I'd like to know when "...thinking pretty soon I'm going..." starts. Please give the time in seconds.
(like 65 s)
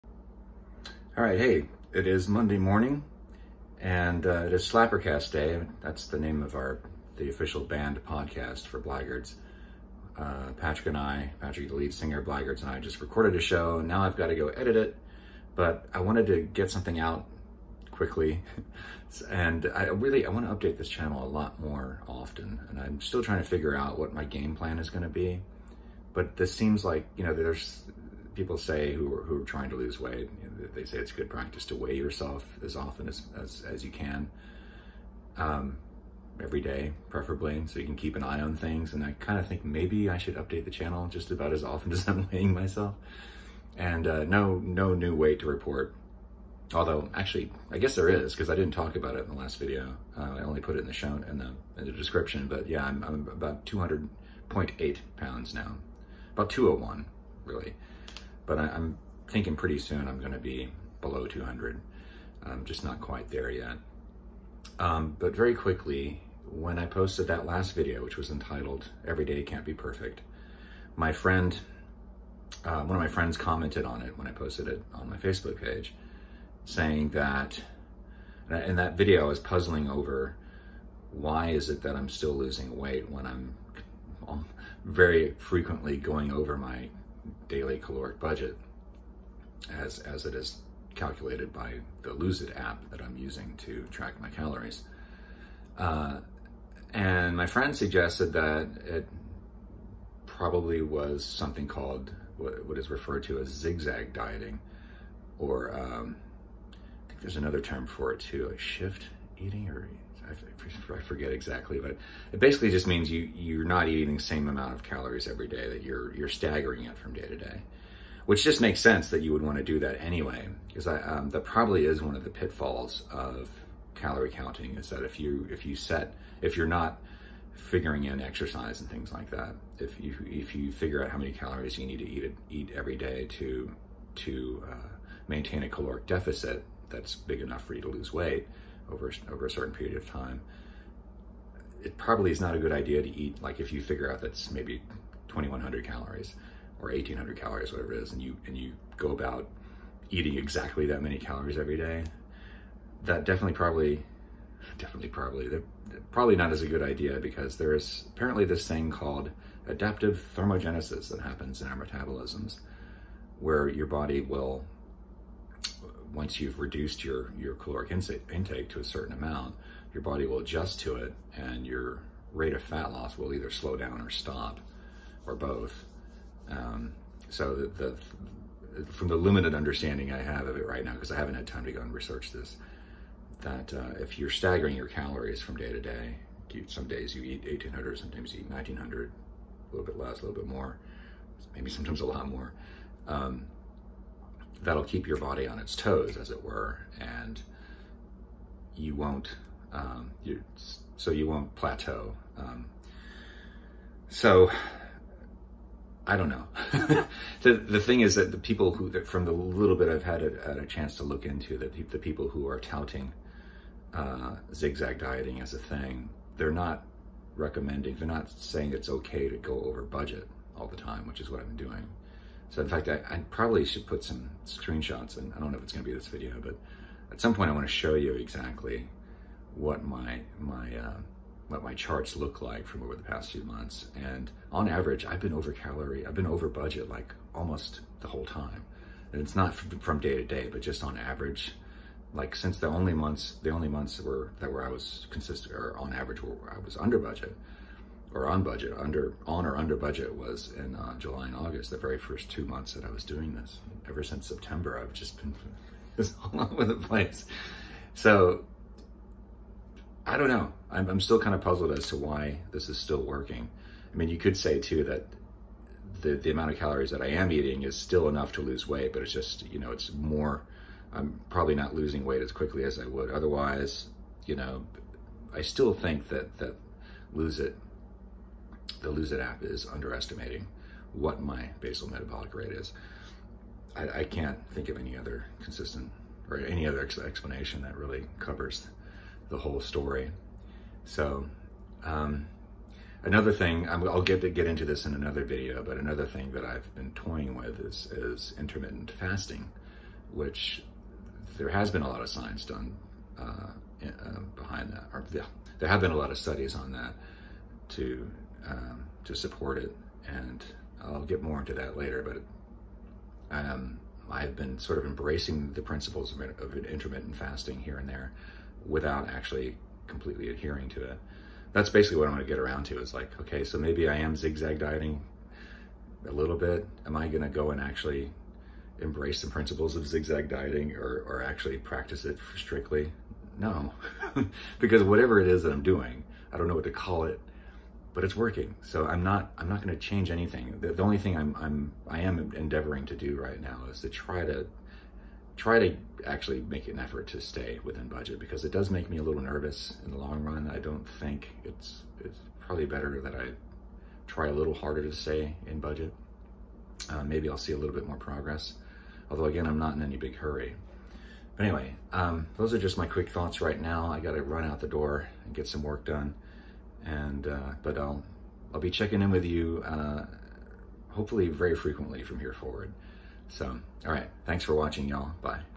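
59 s.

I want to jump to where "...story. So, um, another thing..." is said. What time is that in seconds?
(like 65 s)
289 s.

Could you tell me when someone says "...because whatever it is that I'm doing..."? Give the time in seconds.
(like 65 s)
334 s.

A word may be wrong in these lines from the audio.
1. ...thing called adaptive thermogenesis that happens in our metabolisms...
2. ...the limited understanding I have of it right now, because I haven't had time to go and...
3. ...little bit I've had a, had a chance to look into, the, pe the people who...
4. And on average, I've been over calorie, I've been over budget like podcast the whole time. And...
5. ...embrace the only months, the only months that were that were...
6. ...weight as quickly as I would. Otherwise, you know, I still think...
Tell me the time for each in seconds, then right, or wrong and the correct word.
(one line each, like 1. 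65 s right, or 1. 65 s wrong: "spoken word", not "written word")
1. 158 s right
2. 179 s right
3. 209 s right
4. 233 s wrong: "almost", not "podcast"
5. 242 s wrong: "since", not "embrace"
6. 272 s right.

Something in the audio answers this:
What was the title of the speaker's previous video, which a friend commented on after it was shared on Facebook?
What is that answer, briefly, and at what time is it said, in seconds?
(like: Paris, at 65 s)
Every Day Can't Be Perfect, at 69 s.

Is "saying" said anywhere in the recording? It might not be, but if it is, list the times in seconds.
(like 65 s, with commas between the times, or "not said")
76 s, 218 s.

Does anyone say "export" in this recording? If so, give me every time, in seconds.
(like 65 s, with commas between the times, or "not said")
not said.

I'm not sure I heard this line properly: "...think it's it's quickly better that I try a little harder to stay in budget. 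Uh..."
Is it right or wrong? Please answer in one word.
wrong.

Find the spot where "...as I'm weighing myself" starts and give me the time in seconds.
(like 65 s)
41 s.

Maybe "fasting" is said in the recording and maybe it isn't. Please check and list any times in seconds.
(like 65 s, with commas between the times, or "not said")
298 s, 317 s.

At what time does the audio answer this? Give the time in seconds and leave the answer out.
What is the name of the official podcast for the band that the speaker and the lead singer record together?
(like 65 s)
4 s.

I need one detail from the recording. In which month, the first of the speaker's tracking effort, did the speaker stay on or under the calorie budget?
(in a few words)
July.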